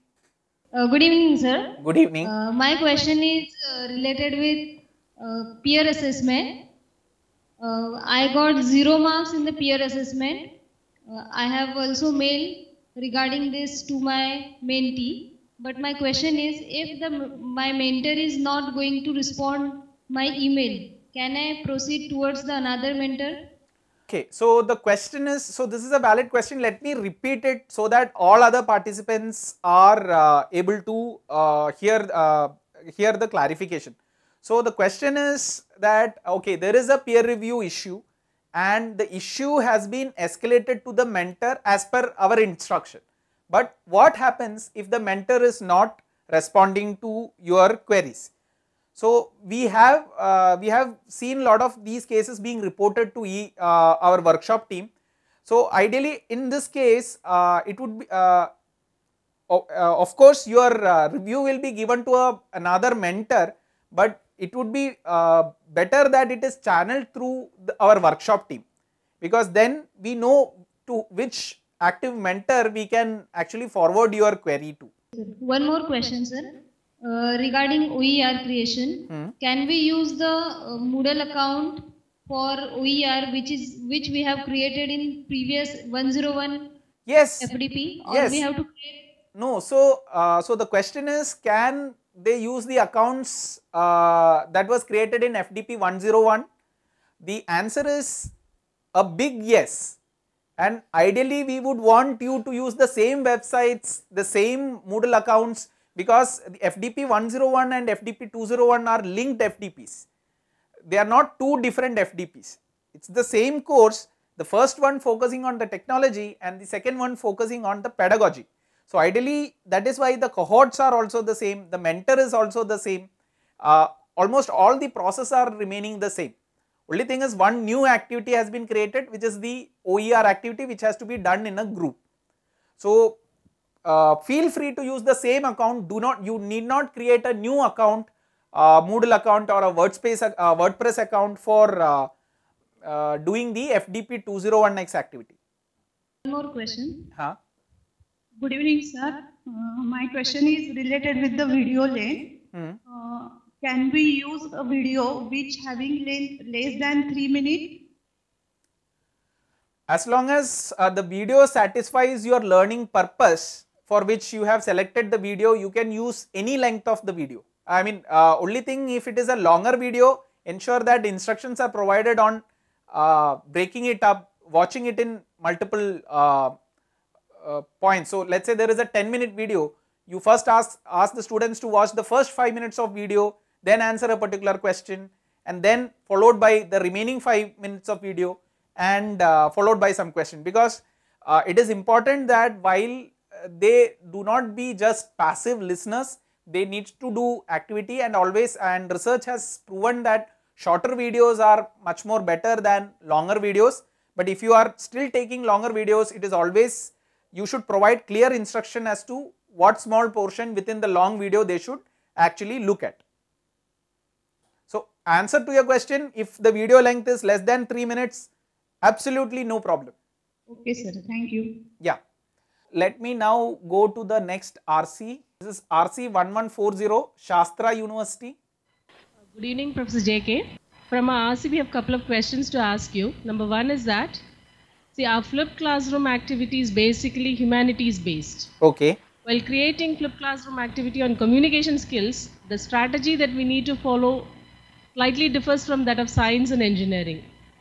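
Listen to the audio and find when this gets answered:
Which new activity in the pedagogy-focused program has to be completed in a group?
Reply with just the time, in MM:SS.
02:09.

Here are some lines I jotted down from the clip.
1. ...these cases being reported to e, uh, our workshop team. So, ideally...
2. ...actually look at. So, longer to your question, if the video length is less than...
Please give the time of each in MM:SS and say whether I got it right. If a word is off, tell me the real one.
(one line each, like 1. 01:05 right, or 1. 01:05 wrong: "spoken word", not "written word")
1. 00:51 right
2. 03:32 wrong: "answer", not "longer".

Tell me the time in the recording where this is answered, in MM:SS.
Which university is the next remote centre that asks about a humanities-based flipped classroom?
03:47.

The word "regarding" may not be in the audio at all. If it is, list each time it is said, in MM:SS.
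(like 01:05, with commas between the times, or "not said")
00:12, 01:17.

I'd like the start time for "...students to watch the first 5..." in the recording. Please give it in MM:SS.
03:01.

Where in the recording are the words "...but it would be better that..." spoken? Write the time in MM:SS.
01:03.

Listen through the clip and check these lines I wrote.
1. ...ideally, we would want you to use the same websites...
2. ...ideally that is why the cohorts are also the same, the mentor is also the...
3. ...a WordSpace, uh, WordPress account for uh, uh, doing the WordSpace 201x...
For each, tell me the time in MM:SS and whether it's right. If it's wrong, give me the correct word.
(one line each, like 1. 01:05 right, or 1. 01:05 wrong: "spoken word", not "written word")
1. 01:40 right
2. 01:58 right
3. 02:19 wrong: "FDP", not "WordSpace".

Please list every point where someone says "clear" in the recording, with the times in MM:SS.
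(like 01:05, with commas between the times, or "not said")
03:28.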